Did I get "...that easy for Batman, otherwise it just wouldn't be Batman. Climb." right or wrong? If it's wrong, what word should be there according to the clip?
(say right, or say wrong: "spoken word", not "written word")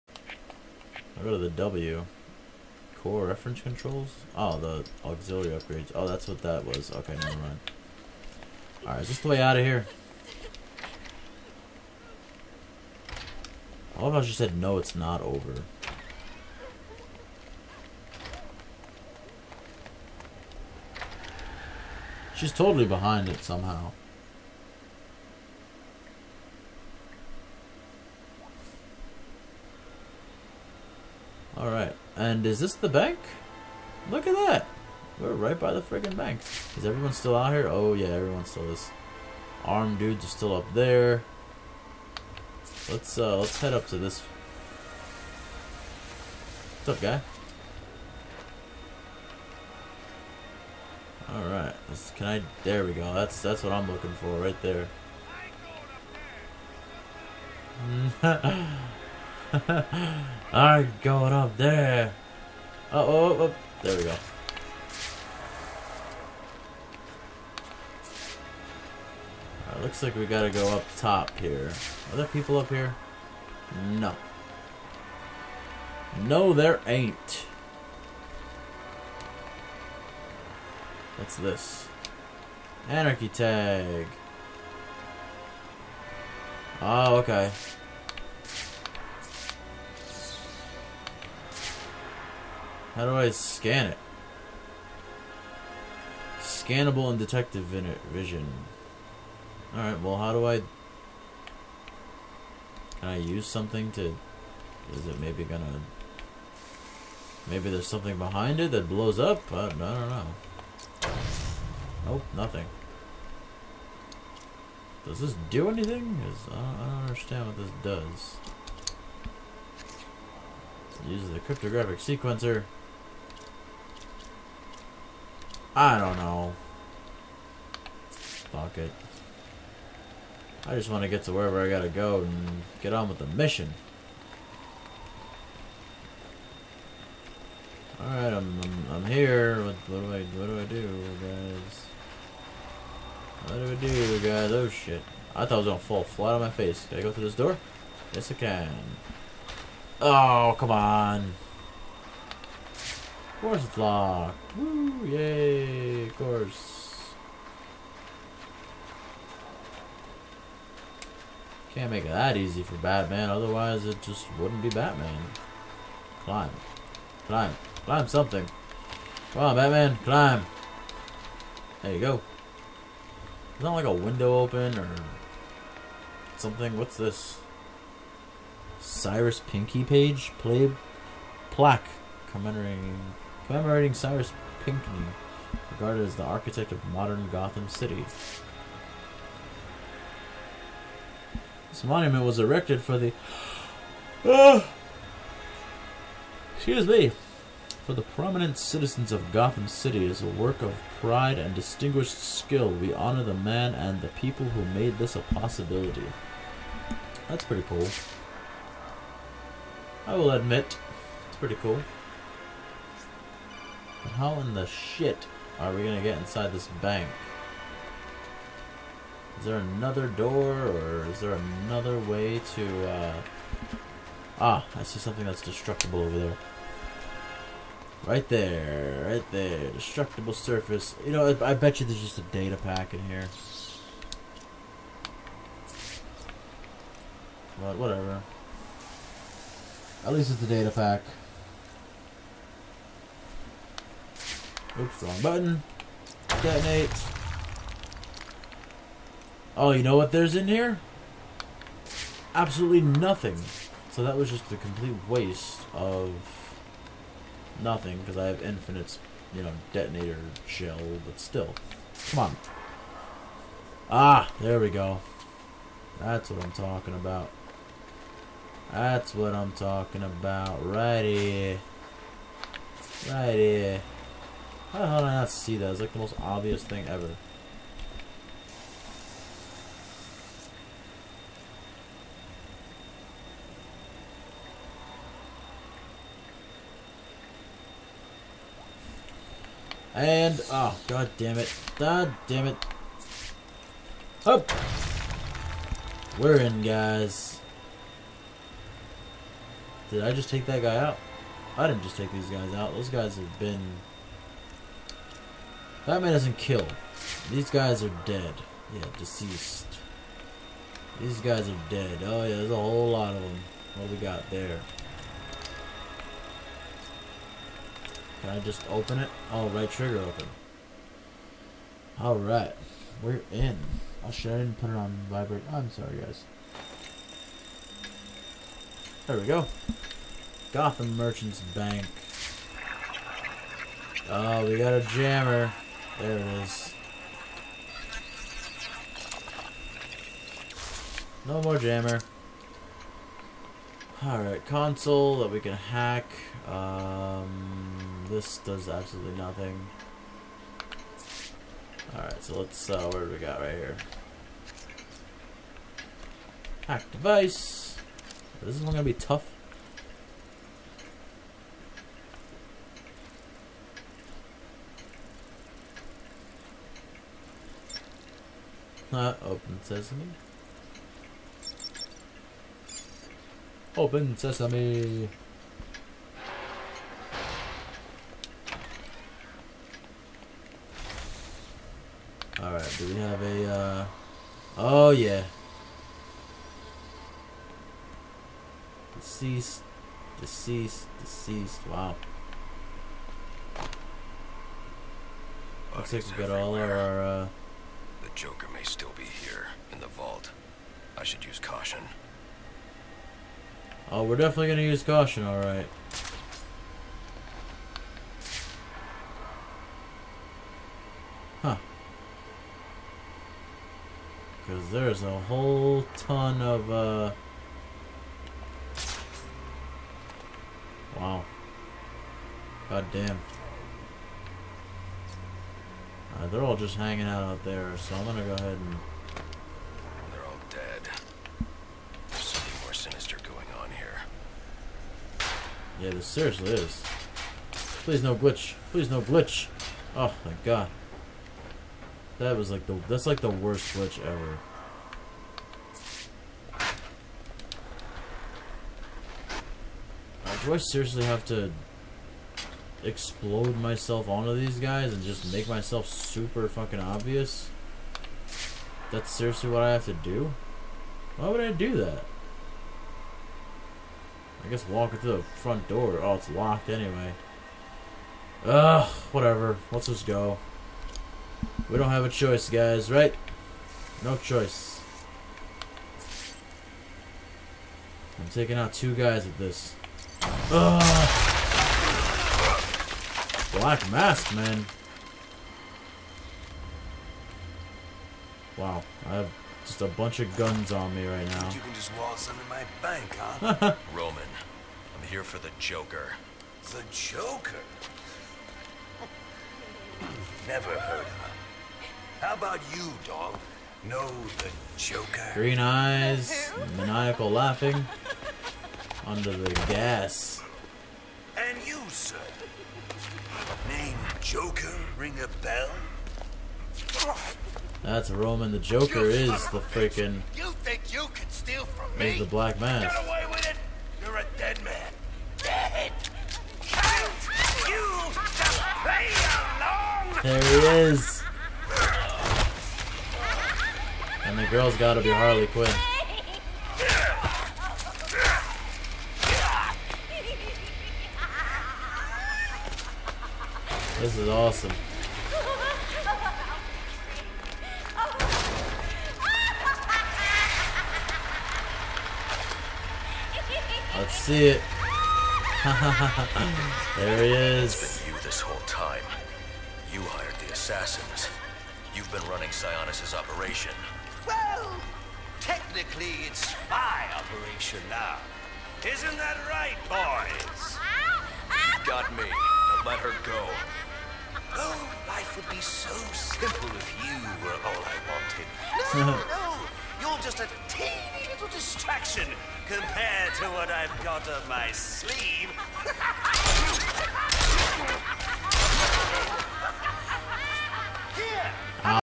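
right.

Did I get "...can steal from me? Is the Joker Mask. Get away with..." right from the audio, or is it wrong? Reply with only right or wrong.
wrong.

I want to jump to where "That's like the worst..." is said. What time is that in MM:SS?
07:22.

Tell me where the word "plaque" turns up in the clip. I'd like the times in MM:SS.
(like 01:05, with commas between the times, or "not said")
03:01.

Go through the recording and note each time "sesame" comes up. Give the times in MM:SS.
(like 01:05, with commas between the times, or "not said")
06:09, 06:14.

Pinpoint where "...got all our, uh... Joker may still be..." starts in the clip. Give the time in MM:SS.
06:36.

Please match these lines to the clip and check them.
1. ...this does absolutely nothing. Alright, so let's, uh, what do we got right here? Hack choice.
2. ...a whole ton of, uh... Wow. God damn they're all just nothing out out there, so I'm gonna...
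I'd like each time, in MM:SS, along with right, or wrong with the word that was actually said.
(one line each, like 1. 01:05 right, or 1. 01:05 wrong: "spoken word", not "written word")
1. 05:48 wrong: "device", not "choice"
2. 06:55 wrong: "hanging", not "nothing".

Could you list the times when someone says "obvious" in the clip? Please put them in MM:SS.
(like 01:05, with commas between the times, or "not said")
04:36, 07:36.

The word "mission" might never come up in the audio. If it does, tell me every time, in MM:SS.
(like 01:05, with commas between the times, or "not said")
02:13.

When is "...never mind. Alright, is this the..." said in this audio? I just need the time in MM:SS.
00:07.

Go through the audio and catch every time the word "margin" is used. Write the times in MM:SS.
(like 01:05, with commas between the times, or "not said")
not said.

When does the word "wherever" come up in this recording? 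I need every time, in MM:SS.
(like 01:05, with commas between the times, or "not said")
02:11.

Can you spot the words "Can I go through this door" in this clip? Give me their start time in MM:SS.
02:26.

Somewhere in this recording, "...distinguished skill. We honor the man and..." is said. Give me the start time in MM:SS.
03:21.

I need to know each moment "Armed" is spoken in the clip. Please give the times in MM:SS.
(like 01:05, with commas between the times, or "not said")
00:39.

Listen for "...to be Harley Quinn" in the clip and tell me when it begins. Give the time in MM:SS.
08:54.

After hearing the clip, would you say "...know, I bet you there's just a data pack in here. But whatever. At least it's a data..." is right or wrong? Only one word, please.
right.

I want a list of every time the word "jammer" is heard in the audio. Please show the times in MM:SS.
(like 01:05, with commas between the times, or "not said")
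05:34, 05:41.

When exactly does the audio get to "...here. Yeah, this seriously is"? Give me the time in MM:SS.
07:13.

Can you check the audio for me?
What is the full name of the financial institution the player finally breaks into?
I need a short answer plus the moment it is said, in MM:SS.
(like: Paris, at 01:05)
Gotham Merchants Bank, at 05:30.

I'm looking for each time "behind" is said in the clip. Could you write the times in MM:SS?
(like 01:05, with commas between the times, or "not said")
00:22, 01:48.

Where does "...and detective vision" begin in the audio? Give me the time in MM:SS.
01:37.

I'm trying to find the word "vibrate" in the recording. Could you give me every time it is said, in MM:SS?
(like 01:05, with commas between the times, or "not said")
05:25.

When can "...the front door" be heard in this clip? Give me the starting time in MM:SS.
07:45.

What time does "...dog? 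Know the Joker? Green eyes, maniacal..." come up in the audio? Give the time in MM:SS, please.
08:23.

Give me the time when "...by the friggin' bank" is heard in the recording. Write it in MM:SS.
00:35.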